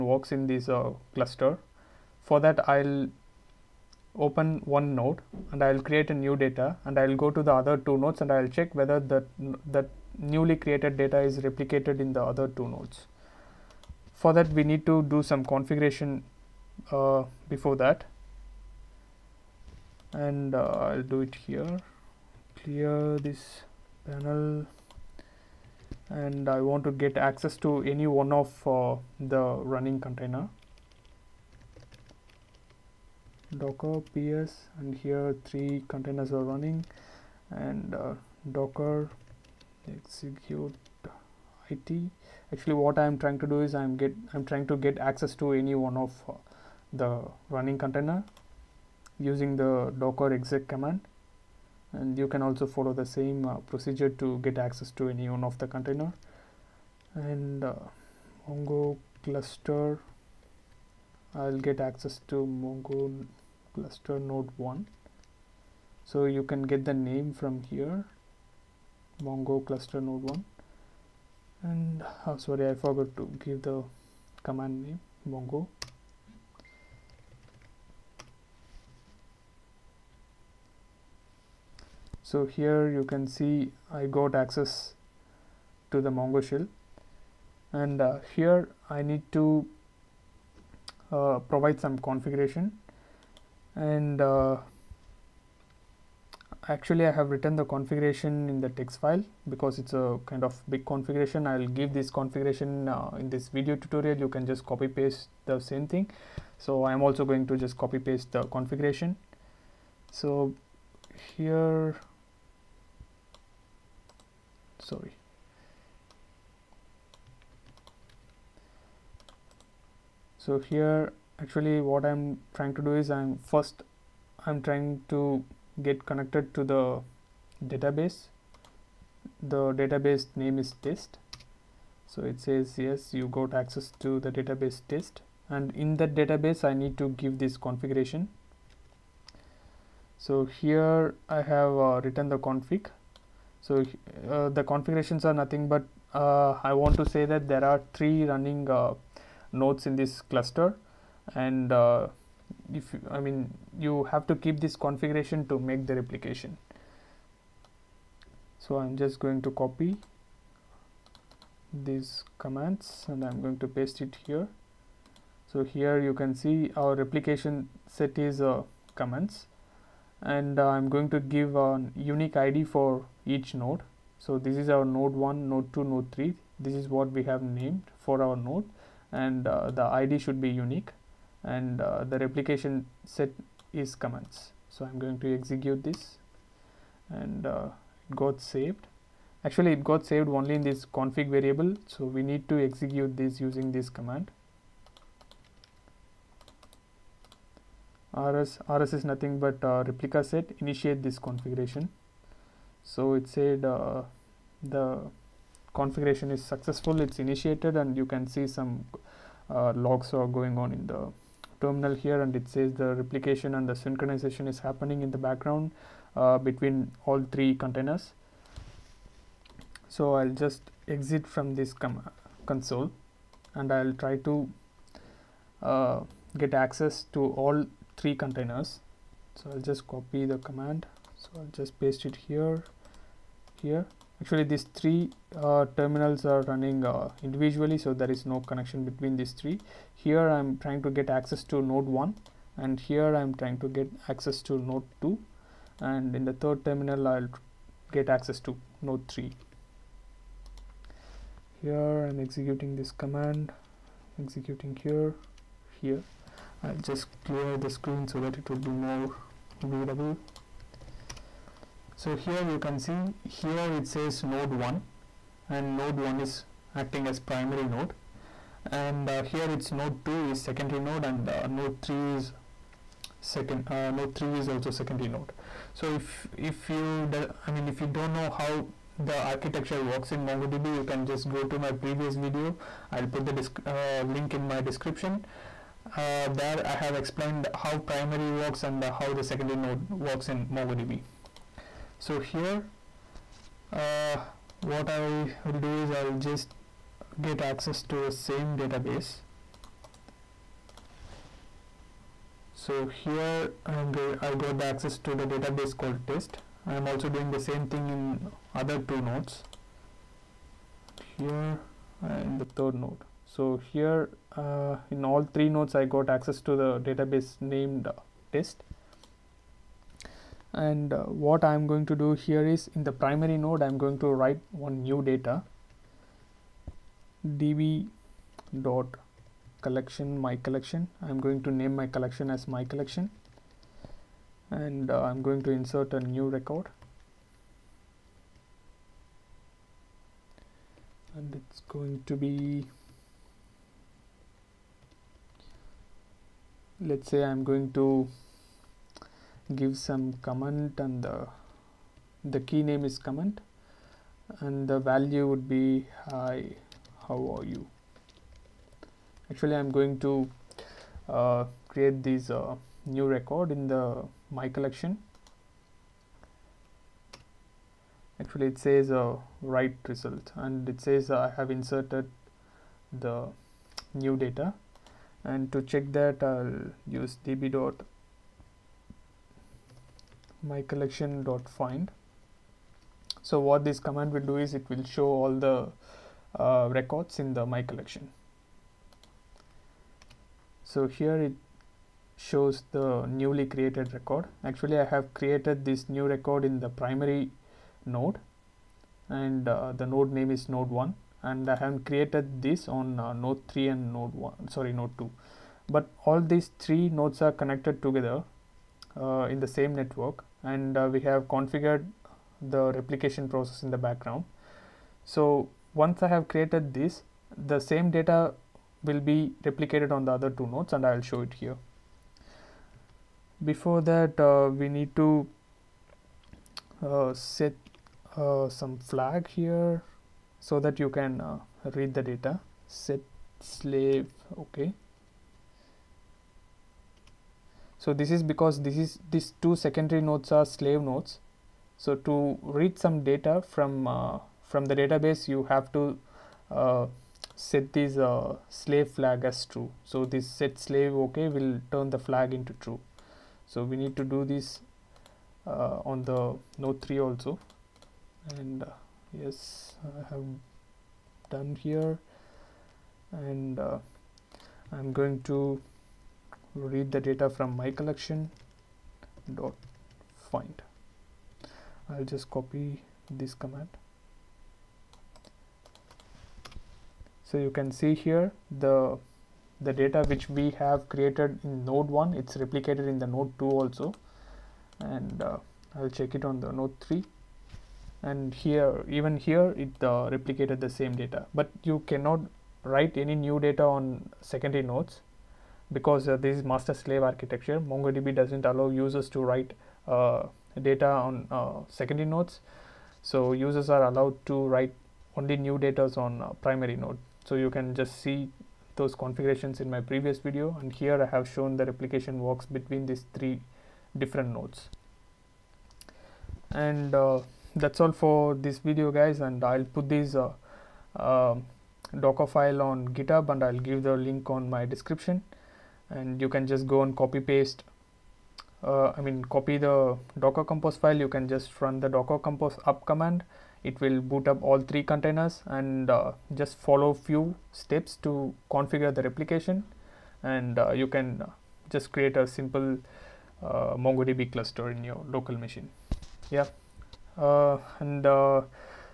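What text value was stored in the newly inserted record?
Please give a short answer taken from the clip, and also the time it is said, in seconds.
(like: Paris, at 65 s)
hi how are you, at 356 s.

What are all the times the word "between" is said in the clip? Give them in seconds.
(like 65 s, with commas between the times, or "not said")
216 s, 238 s, 512 s.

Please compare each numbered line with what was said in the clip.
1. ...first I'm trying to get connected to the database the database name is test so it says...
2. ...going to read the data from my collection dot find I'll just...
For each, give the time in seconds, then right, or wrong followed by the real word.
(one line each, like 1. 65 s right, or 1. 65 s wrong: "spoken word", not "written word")
1. 123 s right
2. 464 s right.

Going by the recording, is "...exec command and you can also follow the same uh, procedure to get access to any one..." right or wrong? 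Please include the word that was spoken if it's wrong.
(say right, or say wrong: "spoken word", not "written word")
right.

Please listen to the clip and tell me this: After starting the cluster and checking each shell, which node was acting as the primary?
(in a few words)
node 1.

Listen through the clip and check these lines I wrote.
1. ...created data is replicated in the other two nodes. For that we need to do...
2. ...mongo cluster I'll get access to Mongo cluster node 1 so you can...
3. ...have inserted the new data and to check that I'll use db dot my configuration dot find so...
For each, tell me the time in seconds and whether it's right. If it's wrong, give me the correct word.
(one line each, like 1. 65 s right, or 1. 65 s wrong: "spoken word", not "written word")
1. 10 s right
2. 58 s right
3. 371 s wrong: "collection", not "configuration".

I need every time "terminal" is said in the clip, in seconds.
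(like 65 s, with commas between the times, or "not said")
211 s, 235 s, 246 s.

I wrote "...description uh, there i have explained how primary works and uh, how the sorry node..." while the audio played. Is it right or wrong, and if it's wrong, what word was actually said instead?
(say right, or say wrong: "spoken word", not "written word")
wrong: "secondary", not "sorry".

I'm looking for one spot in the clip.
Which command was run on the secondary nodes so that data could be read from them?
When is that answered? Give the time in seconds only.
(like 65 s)
450 s.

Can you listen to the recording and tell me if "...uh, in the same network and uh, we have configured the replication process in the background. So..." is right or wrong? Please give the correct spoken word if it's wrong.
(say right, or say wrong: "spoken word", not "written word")
right.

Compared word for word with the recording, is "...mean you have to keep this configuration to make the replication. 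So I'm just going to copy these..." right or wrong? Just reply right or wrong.
right.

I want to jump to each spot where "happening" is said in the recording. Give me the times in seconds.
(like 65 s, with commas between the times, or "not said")
214 s.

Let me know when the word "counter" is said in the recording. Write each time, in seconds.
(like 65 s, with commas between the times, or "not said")
not said.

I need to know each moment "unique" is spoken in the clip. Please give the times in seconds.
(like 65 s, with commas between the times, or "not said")
171 s, 180 s.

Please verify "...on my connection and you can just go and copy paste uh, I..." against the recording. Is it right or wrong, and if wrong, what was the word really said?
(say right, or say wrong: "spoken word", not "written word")
wrong: "description", not "connection".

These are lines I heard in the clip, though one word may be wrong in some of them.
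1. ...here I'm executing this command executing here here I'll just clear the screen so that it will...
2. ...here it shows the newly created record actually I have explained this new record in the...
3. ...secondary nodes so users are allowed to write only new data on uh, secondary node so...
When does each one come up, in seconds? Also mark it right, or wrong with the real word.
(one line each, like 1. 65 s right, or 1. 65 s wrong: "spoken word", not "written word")
1. 251 s right
2. 390 s wrong: "created", not "explained"
3. 501 s wrong: "primary", not "secondary".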